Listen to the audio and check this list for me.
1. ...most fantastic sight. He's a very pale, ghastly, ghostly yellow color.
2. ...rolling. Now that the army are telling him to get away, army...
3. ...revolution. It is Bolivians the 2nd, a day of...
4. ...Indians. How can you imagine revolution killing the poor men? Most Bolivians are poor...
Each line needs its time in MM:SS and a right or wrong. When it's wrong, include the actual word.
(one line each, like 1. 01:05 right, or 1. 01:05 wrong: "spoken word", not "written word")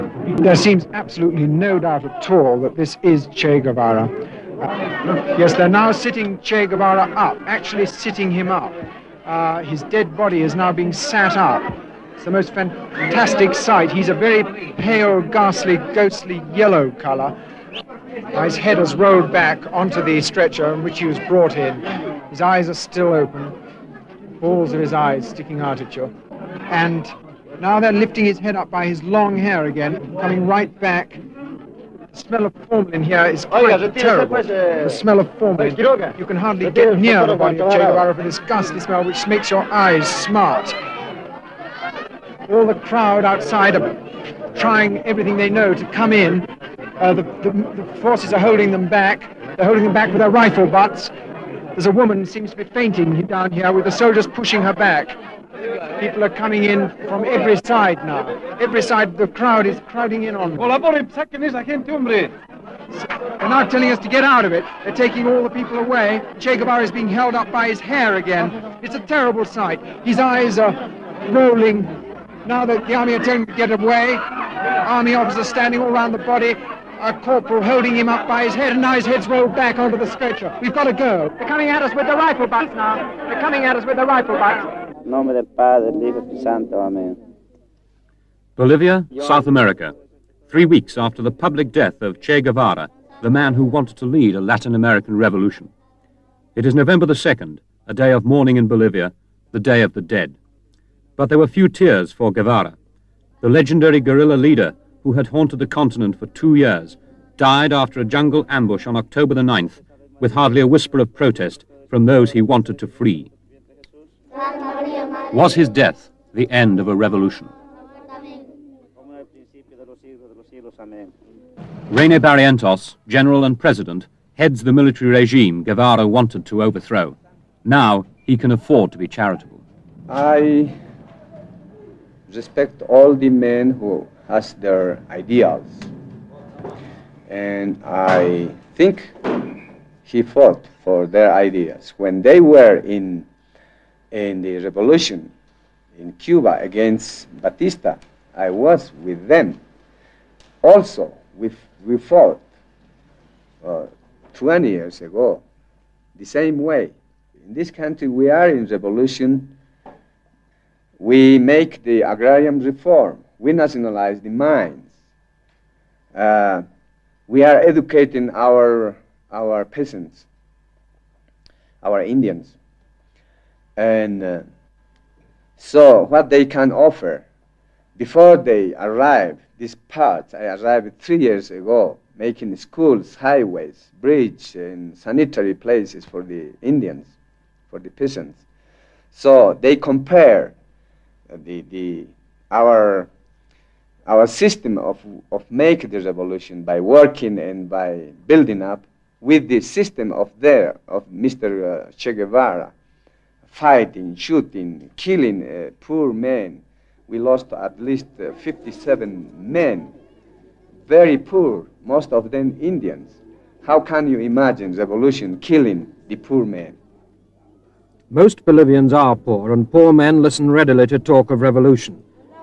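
1. 00:12 right
2. 01:11 right
3. 01:35 wrong: "November", not "Bolivians"
4. 03:32 right.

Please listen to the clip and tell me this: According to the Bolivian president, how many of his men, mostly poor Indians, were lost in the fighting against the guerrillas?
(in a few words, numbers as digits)
57.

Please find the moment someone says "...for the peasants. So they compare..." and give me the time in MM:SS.
03:07.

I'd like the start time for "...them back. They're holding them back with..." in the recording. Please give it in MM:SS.
00:48.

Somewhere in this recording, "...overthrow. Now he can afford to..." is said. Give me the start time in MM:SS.
02:06.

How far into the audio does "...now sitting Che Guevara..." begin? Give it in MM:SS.
00:05.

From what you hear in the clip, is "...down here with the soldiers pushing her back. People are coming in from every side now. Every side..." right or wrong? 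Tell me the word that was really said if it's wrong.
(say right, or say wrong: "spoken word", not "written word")
right.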